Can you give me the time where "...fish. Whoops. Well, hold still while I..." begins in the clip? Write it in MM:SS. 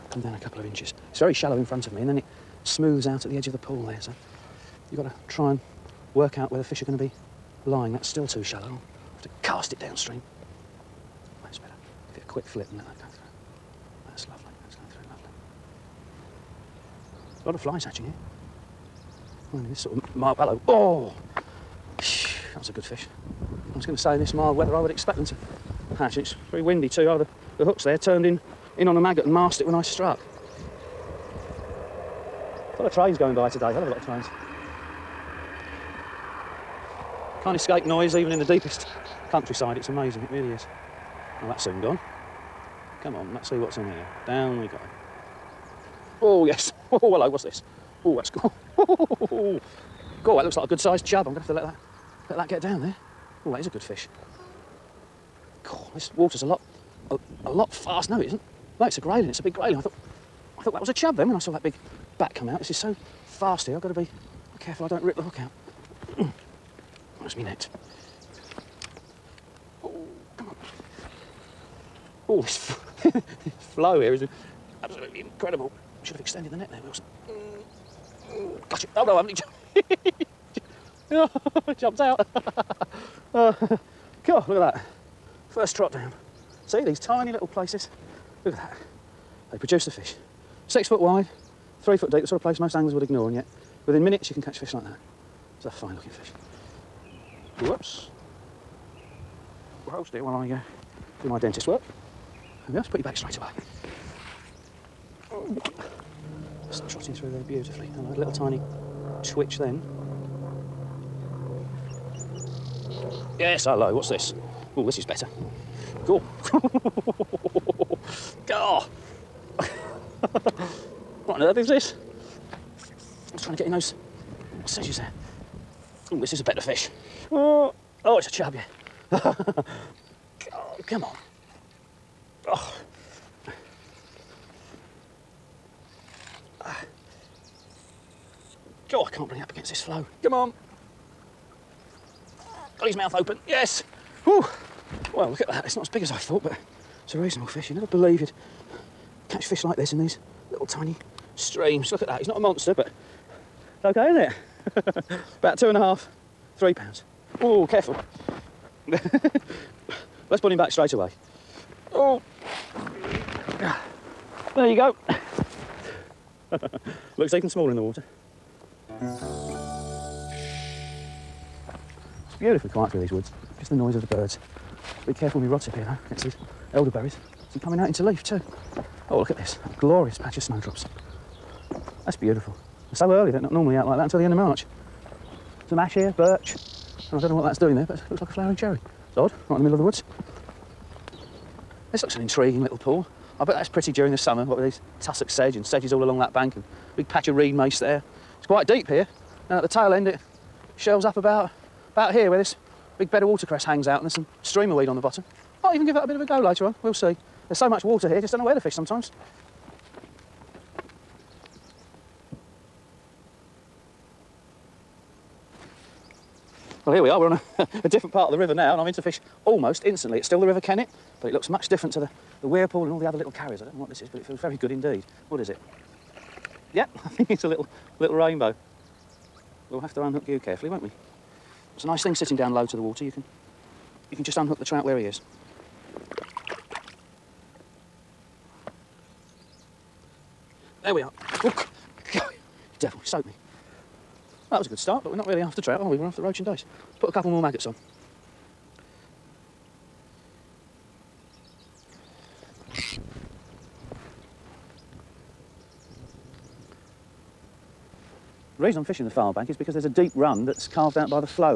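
01:36.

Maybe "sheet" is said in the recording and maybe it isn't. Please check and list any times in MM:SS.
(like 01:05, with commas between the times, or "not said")
not said.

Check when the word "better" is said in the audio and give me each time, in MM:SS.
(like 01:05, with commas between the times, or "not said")
01:55, 02:06.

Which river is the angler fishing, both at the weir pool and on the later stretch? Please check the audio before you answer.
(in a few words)
River Kennet.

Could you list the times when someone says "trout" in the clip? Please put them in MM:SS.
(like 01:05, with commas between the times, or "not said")
03:54, 04:05.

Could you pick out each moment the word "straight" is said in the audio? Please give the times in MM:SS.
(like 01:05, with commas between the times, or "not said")
01:43, 02:40.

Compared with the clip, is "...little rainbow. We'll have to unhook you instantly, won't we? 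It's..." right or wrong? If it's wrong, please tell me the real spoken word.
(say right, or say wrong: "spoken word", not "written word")
wrong: "carefully", not "instantly".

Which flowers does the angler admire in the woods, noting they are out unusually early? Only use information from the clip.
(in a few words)
Snowdrops.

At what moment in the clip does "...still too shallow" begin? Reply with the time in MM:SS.
00:08.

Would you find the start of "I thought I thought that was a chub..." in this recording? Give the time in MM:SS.
00:59.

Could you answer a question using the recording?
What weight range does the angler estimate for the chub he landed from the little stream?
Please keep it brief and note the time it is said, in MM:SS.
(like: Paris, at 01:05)
2.5 to 3 pounds, at 02:35.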